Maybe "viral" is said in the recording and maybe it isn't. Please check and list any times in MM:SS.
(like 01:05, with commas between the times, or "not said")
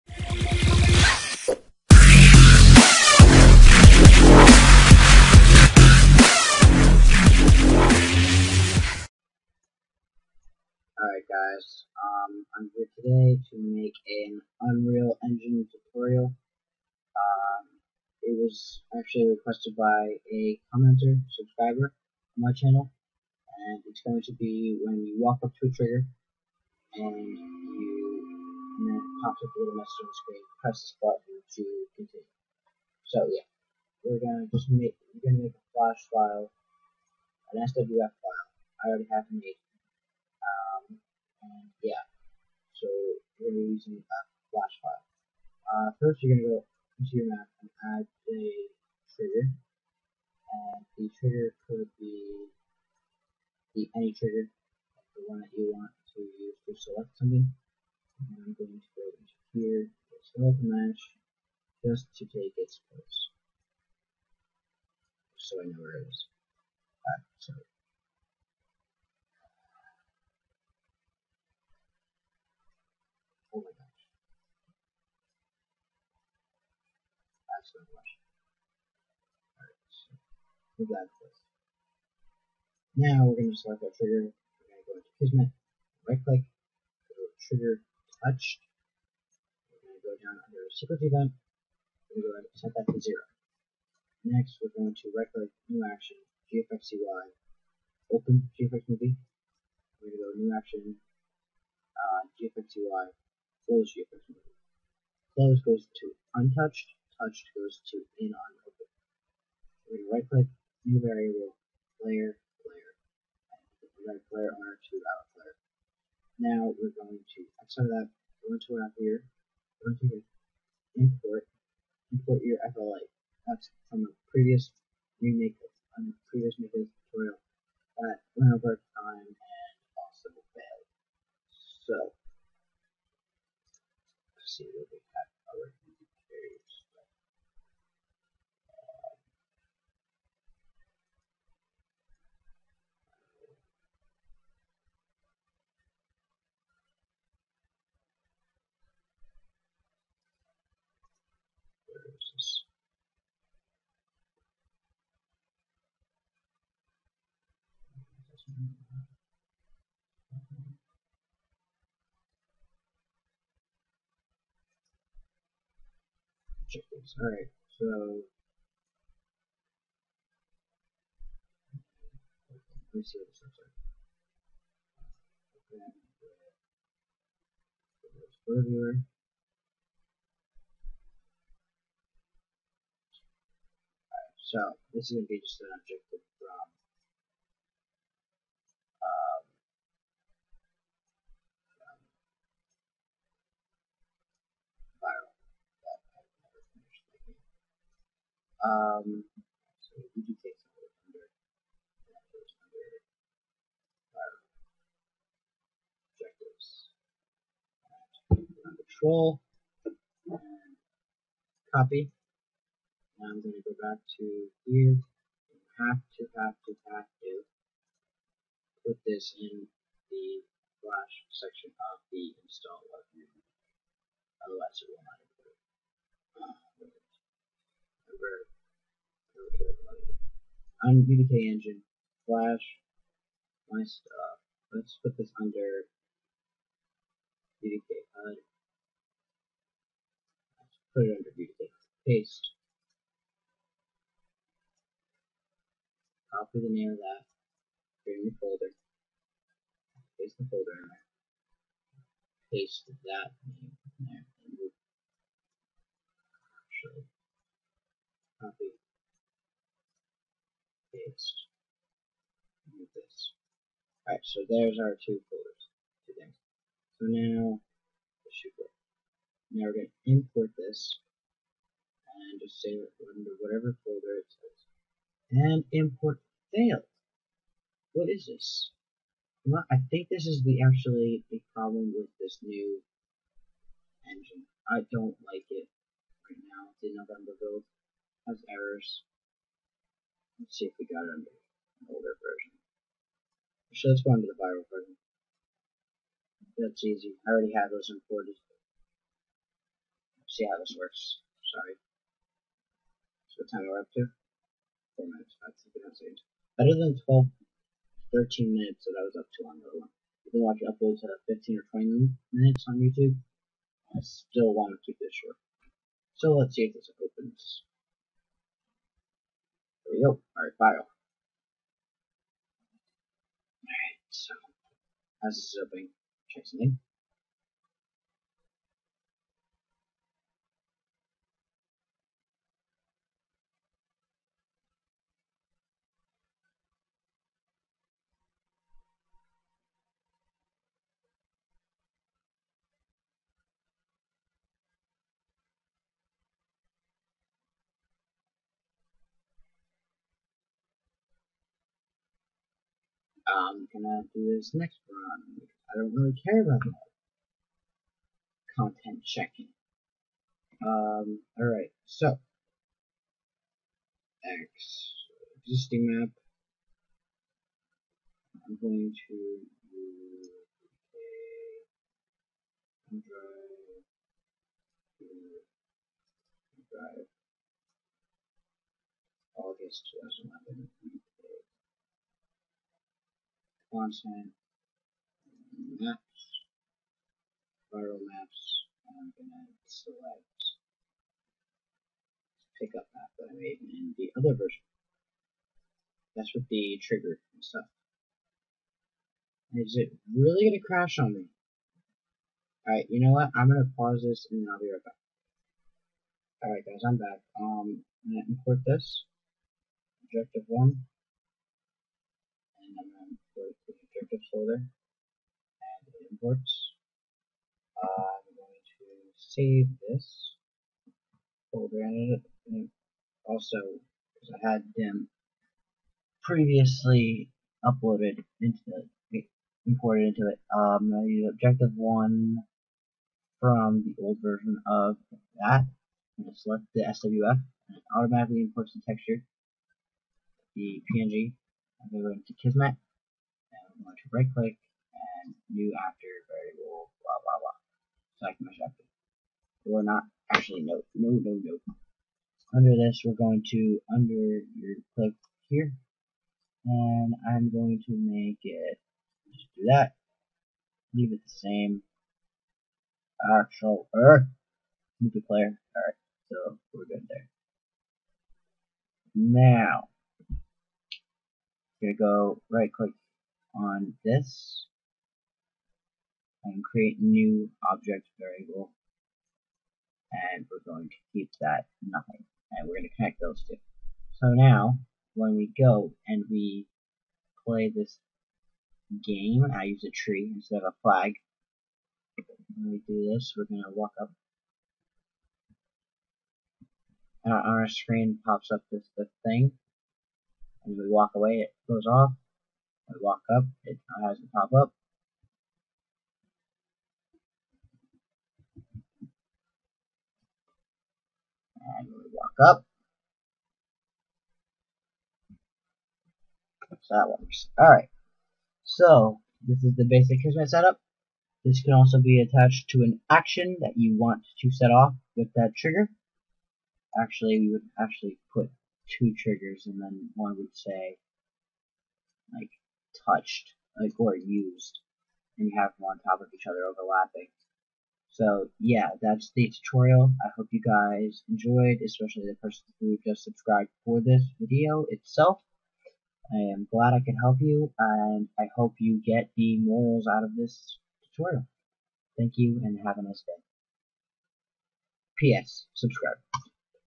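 04:54, 06:27.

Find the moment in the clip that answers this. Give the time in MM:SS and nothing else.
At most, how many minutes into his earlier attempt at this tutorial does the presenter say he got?
05:08.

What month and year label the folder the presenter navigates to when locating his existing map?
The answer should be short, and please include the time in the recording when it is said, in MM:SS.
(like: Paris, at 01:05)
August 2011, at 06:19.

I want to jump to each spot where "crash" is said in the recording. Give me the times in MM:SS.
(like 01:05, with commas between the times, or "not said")
06:40.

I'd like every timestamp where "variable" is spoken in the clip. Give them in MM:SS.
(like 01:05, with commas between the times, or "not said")
01:50, 07:26, 07:58.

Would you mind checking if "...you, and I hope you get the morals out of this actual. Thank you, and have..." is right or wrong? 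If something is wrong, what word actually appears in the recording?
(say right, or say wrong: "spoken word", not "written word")
wrong: "tutorial", not "actual".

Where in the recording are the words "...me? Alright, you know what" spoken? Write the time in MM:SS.
06:41.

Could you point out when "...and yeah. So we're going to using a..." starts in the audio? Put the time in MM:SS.
00:41.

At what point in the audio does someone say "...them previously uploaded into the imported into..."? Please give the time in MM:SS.
07:04.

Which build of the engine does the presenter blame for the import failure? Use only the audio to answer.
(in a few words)
November build.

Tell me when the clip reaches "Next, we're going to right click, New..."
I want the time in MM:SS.
01:34.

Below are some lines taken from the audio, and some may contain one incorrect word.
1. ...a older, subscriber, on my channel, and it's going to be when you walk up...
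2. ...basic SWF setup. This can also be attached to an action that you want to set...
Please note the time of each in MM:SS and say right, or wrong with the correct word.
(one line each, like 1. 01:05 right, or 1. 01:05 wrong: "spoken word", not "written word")
1. 00:20 wrong: "commenter", not "older"
2. 08:39 wrong: "Kismet", not "SWF".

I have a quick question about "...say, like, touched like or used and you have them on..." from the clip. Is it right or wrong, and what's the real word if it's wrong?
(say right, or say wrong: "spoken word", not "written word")
right.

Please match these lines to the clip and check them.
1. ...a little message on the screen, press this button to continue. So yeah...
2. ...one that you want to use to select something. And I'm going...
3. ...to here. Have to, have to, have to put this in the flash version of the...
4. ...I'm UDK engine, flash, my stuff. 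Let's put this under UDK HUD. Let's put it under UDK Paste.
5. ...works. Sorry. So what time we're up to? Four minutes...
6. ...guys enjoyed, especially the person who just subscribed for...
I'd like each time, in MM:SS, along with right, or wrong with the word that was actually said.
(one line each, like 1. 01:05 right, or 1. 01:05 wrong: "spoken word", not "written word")
1. 00:29 right
2. 00:55 right
3. 03:34 wrong: "section", not "version"
4. 03:50 right
5. 05:00 right
6. 09:00 right.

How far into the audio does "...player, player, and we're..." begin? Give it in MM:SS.
01:52.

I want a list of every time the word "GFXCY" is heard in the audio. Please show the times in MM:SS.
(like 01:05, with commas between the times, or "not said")
01:36, 01:42.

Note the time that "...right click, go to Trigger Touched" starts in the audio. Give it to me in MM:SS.
01:26.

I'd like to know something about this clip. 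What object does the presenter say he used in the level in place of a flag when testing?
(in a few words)
a tree.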